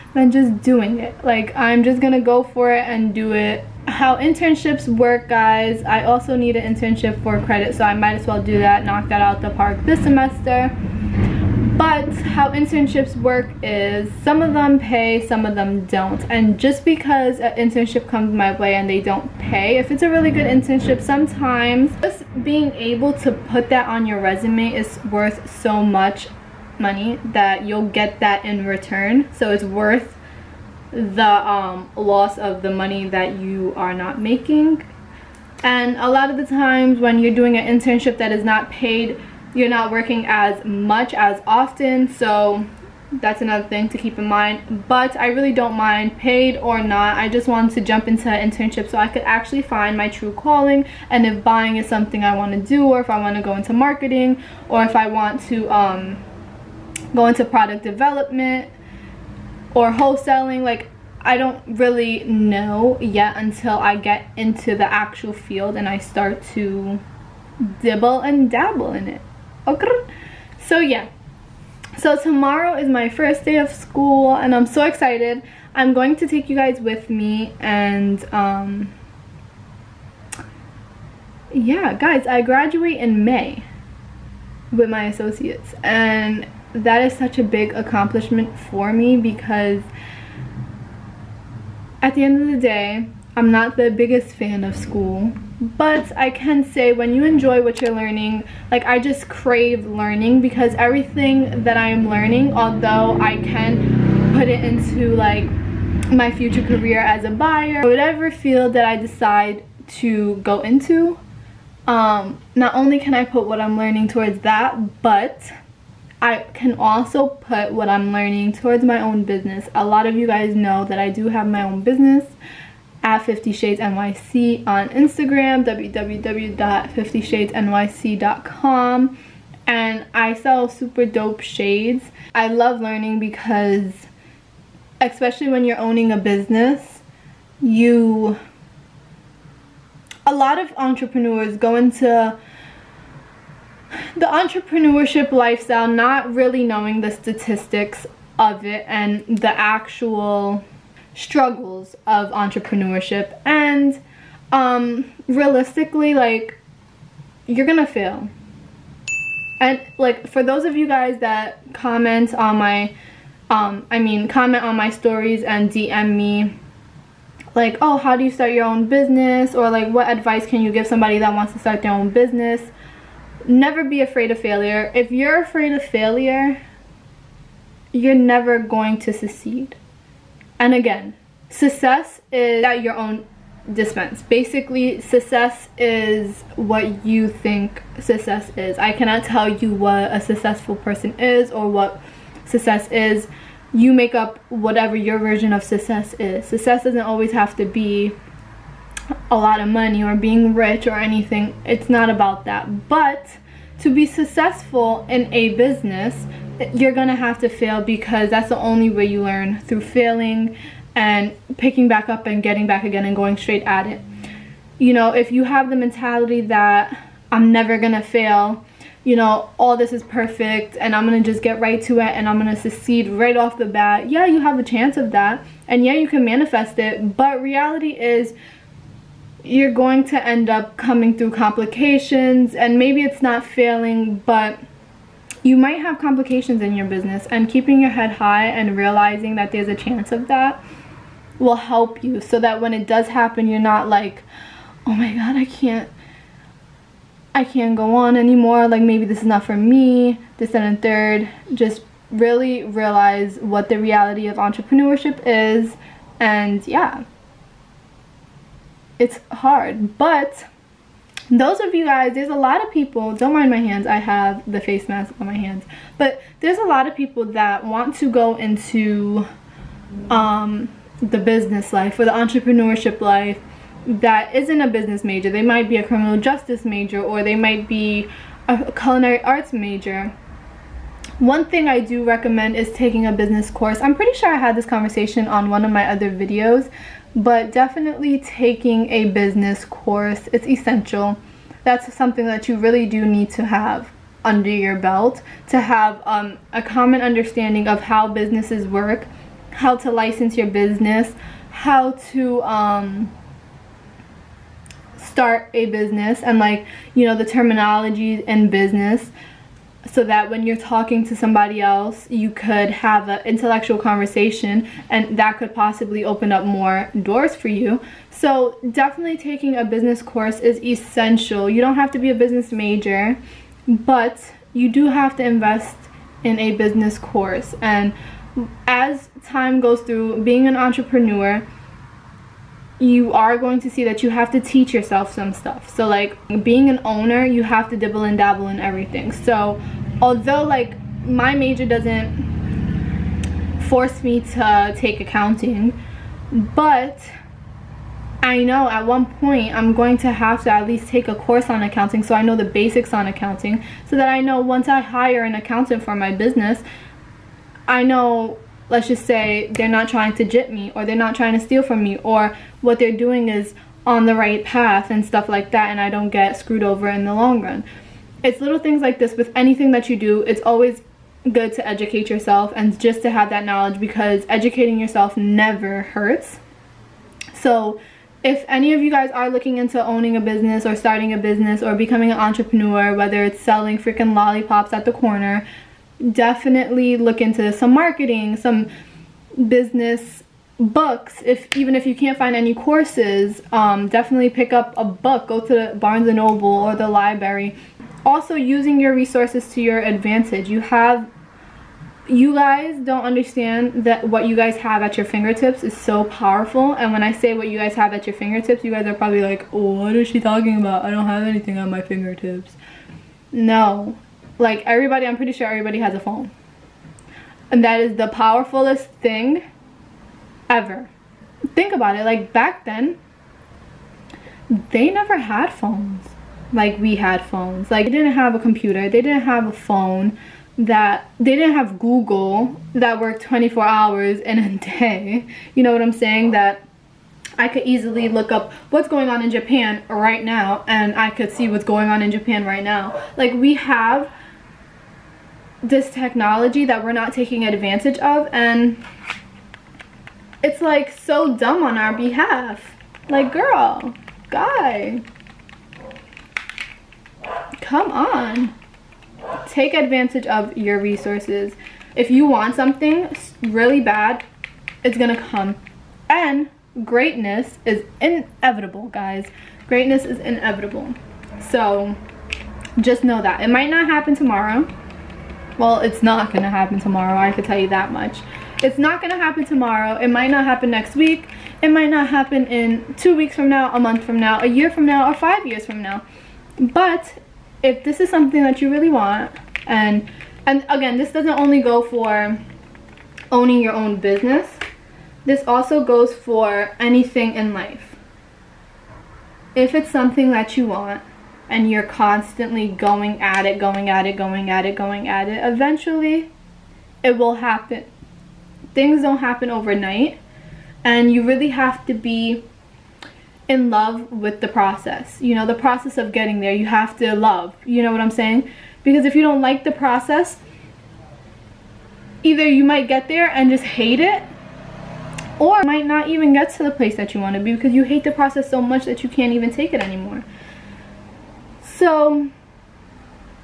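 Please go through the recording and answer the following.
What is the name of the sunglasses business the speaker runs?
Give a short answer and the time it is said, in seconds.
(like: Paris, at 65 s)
50 Shades NYC, at 123 s.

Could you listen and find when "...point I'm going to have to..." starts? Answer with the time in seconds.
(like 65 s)
349 s.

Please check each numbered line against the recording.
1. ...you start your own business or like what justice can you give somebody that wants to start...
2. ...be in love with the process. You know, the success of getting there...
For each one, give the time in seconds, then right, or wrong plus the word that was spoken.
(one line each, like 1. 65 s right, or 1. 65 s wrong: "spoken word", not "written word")
1. 168 s wrong: "advice", not "justice"
2. 511 s wrong: "process", not "success".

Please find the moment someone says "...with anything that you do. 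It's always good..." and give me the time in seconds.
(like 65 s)
369 s.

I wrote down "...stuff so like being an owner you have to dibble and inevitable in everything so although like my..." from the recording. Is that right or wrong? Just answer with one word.
wrong.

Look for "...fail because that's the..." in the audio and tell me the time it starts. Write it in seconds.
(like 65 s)
207 s.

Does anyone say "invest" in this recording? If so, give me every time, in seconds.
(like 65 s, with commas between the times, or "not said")
325 s.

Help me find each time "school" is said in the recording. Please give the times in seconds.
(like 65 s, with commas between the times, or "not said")
73 s, 94 s.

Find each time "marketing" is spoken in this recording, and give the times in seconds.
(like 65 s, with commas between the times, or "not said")
53 s, 387 s.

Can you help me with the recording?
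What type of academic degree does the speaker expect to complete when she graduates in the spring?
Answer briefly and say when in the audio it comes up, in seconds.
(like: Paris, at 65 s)
Associates, at 85 s.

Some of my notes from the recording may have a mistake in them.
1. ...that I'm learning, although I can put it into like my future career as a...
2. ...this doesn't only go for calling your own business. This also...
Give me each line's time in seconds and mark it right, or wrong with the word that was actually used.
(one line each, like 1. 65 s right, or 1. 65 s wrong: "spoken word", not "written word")
1. 101 s right
2. 490 s wrong: "owning", not "calling".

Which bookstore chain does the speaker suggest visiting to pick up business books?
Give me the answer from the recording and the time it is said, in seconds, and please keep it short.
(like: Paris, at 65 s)
Barnes and Noble, at 395 s.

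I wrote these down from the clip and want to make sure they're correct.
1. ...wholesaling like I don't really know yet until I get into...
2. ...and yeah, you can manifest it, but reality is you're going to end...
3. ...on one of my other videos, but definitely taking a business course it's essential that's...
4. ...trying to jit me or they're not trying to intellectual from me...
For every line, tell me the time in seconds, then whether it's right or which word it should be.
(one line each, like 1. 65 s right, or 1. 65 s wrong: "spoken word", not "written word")
1. 59 s right
2. 225 s right
3. 285 s right
4. 359 s wrong: "steal", not "intellectual".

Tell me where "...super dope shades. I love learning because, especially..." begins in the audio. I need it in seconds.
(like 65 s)
130 s.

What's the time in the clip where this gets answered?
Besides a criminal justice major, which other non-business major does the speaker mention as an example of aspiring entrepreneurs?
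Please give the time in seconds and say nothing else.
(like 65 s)
278 s.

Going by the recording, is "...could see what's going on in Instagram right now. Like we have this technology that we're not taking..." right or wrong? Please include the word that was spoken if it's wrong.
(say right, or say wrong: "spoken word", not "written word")
wrong: "Japan", not "Instagram".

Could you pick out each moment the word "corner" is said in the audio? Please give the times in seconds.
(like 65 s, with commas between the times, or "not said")
384 s.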